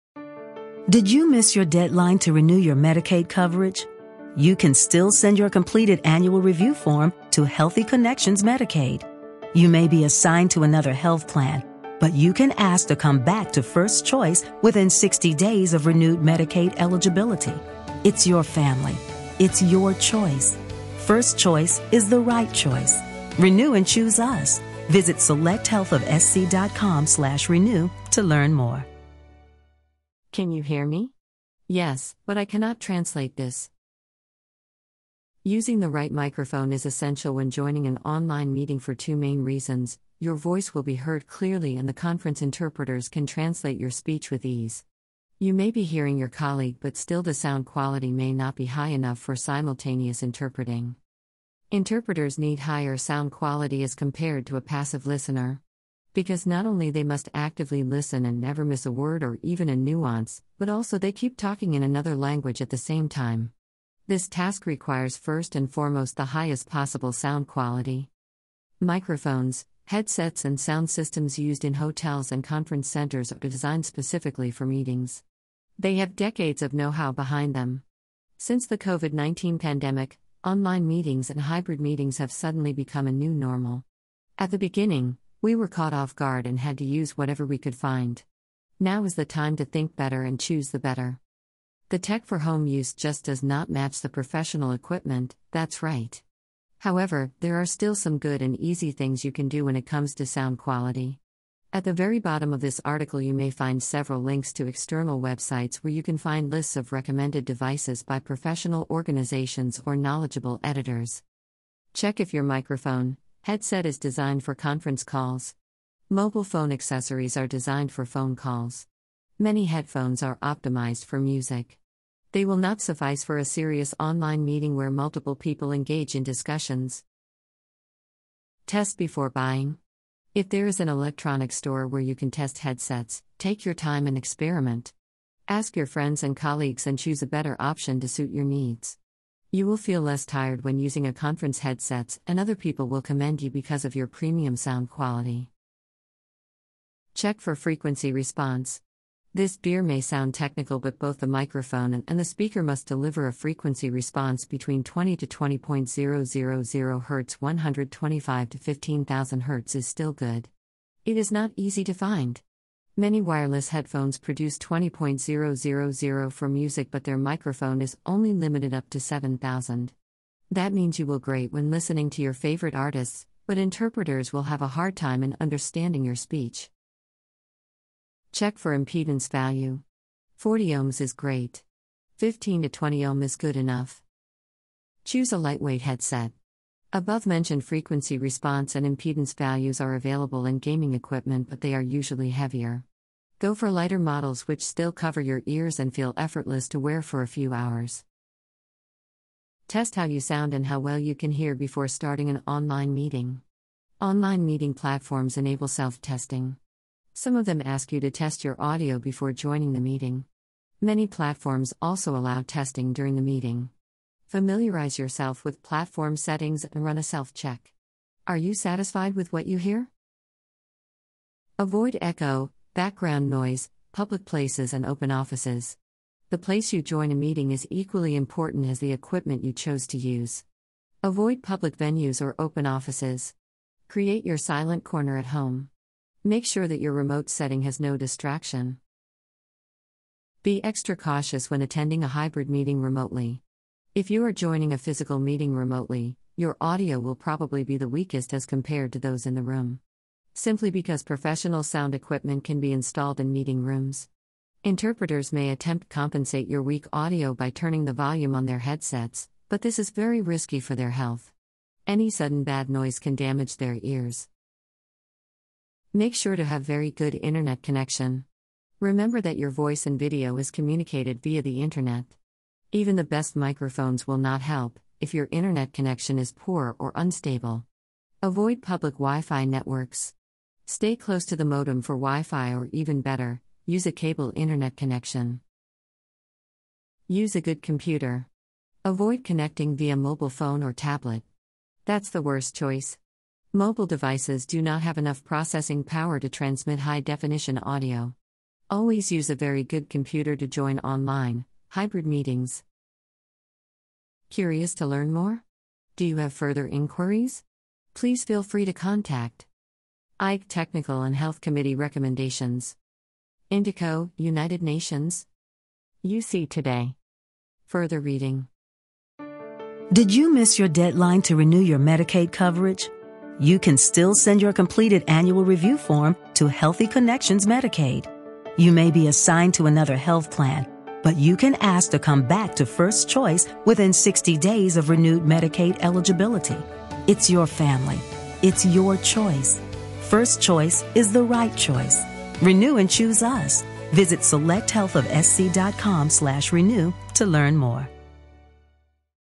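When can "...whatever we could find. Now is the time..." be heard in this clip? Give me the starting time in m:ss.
1:27.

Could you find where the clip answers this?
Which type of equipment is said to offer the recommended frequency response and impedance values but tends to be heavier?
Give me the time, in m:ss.
3:10.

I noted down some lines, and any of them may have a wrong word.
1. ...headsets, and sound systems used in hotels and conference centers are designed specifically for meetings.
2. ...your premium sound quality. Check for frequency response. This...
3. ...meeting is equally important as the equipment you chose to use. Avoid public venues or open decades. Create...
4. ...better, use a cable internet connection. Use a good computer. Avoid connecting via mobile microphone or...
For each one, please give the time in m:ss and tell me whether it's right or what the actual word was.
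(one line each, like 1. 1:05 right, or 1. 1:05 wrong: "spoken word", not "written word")
1. 1:09 right
2. 2:23 right
3. 3:47 wrong: "offices", not "decades"
4. 4:43 wrong: "phone", not "microphone".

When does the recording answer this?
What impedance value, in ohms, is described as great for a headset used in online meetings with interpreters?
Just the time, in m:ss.
3:00.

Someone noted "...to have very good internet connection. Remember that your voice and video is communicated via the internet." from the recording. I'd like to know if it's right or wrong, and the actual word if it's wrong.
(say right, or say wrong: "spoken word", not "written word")
right.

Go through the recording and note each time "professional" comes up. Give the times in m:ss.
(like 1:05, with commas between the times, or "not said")
1:34, 1:48, 4:11.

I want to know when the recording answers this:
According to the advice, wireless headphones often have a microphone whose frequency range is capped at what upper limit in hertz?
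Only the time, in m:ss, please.
2:48.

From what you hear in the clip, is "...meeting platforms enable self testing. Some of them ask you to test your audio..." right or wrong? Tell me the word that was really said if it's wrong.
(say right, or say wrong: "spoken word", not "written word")
right.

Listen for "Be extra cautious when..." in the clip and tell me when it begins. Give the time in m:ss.
4:00.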